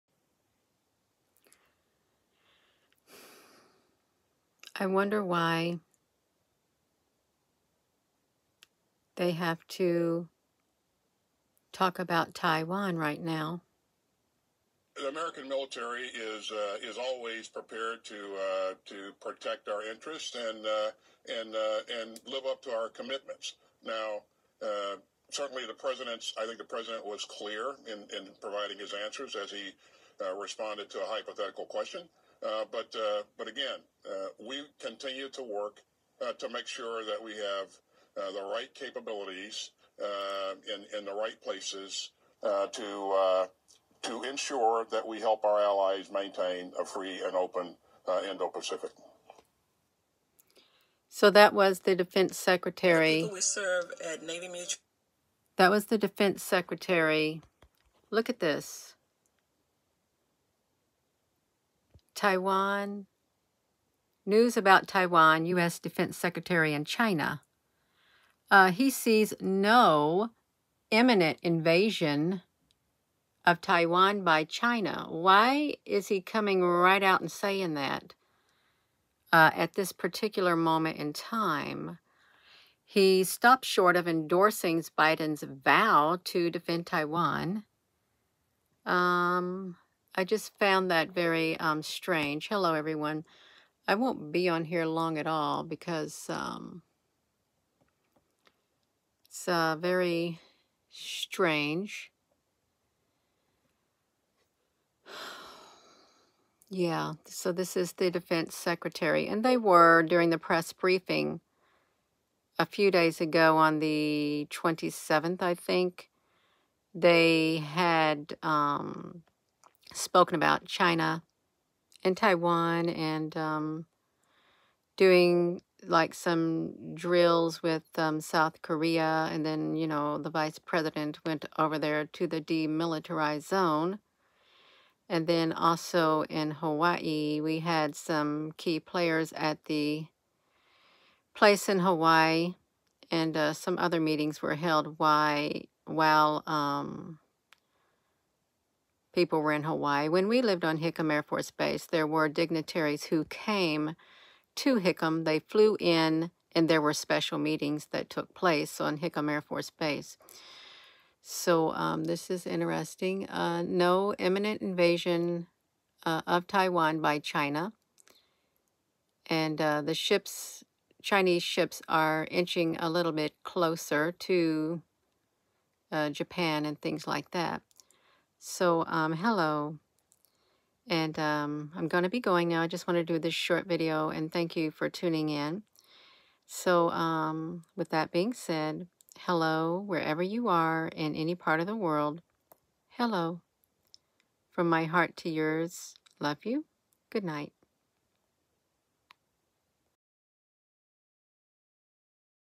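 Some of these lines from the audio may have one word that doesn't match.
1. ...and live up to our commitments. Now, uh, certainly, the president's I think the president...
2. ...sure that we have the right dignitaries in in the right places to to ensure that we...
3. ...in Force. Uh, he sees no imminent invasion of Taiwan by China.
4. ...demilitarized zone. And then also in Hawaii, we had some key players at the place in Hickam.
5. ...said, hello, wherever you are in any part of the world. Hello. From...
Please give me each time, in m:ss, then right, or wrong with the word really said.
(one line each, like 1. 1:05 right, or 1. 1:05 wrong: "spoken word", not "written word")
1. 0:22 right
2. 0:36 wrong: "capabilities", not "dignitaries"
3. 1:06 wrong: "China", not "Force"
4. 2:12 wrong: "Hawaii", not "Hickam"
5. 3:08 right.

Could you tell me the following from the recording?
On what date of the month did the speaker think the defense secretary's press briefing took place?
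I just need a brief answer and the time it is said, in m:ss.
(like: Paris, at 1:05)
27th, at 1:54.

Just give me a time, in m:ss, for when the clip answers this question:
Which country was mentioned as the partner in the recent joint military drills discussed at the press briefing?
2:08.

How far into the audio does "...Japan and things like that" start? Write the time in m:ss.
2:56.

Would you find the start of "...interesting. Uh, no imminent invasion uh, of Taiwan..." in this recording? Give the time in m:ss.
2:42.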